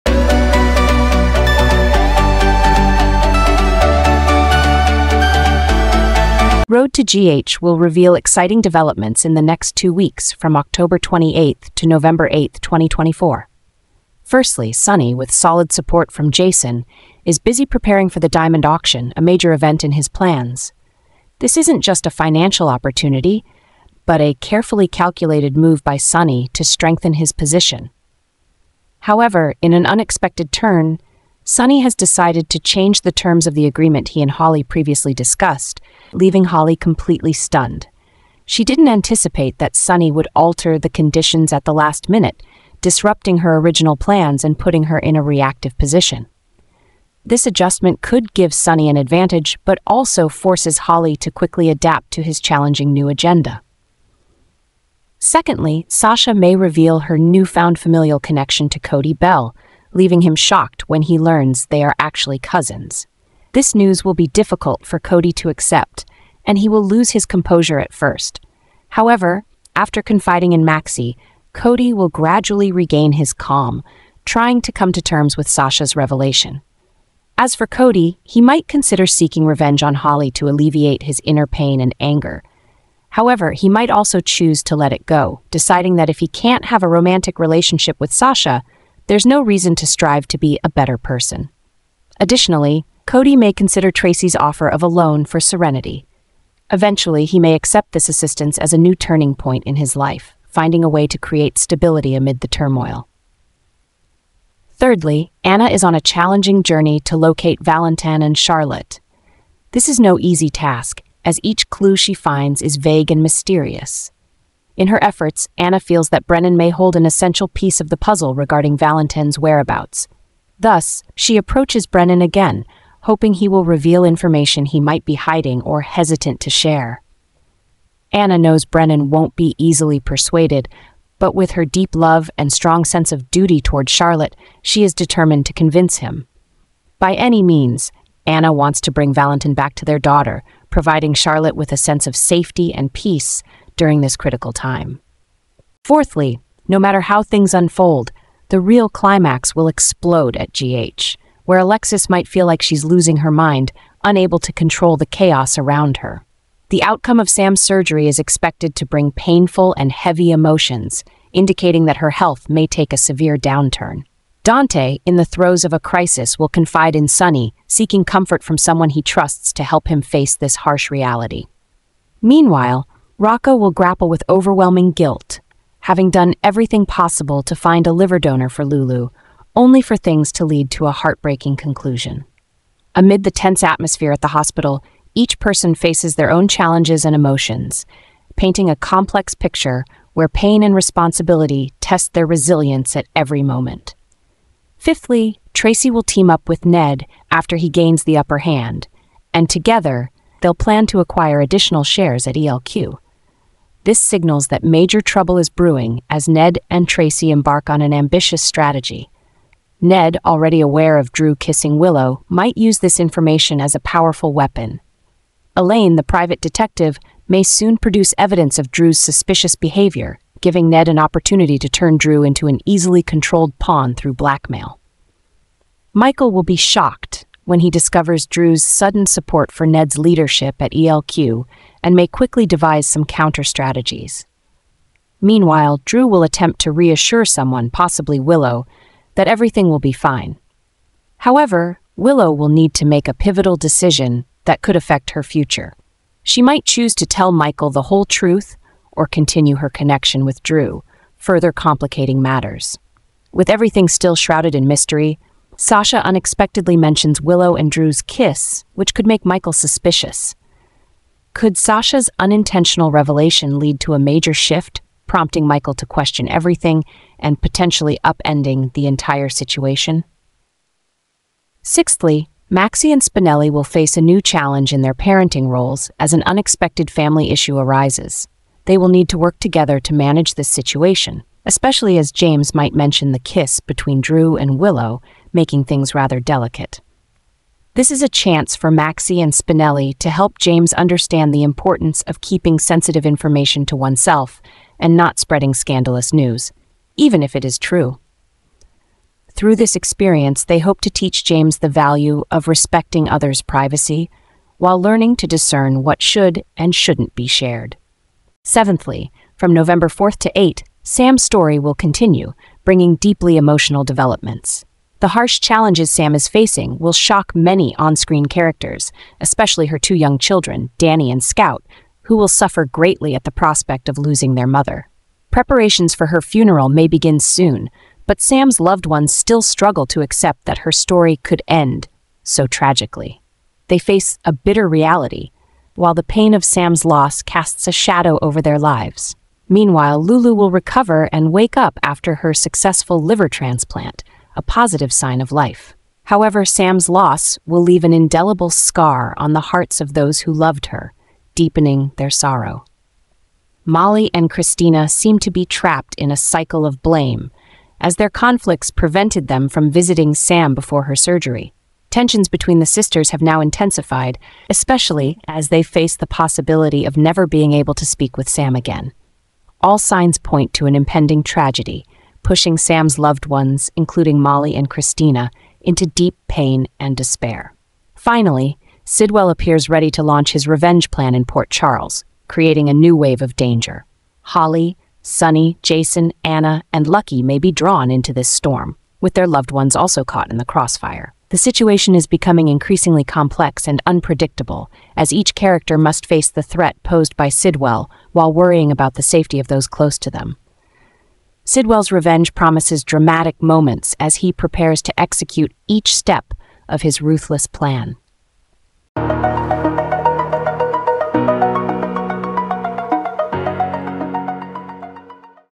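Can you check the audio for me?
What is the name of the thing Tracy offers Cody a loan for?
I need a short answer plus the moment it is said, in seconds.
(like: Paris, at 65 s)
Serenity, at 95 s.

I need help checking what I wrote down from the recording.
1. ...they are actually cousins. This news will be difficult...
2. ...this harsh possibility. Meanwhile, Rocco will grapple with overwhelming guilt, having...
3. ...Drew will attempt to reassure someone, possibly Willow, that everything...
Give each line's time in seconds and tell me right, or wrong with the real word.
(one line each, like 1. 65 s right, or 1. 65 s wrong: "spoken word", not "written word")
1. 61 s right
2. 170 s wrong: "reality", not "possibility"
3. 235 s right.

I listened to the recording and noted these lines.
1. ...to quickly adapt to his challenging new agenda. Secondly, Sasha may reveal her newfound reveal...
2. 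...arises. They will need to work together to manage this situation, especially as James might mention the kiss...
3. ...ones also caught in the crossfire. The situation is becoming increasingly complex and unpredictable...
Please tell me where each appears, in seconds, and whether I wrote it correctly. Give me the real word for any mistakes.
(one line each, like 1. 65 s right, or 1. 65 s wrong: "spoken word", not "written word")
1. 51 s wrong: "familial", not "reveal"
2. 277 s right
3. 389 s right.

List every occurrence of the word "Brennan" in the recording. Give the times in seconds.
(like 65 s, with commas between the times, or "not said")
116 s, 121 s, 128 s.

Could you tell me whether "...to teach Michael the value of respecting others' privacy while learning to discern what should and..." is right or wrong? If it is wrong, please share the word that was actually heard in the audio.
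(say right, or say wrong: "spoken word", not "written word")
wrong: "James", not "Michael".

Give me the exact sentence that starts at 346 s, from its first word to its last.
However, Sam's loss will leave an indelible scar on the hearts of those who loved her, deepening their sorrow.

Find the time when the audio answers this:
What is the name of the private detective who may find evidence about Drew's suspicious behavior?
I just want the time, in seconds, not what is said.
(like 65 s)
215 s.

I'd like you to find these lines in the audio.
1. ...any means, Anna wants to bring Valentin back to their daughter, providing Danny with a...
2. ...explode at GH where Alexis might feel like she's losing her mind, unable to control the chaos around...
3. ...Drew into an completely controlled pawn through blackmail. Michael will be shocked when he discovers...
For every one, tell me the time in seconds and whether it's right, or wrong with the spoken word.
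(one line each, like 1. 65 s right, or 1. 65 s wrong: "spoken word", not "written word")
1. 137 s wrong: "Charlotte", not "Danny"
2. 149 s right
3. 221 s wrong: "easily", not "completely".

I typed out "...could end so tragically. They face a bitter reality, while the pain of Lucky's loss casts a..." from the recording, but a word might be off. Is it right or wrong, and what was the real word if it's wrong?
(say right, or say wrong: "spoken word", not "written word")
wrong: "Sam", not "Lucky".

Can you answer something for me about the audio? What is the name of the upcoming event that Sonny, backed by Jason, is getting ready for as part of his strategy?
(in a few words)
Diamond Auction.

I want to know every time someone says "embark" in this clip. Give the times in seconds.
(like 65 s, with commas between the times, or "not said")
207 s.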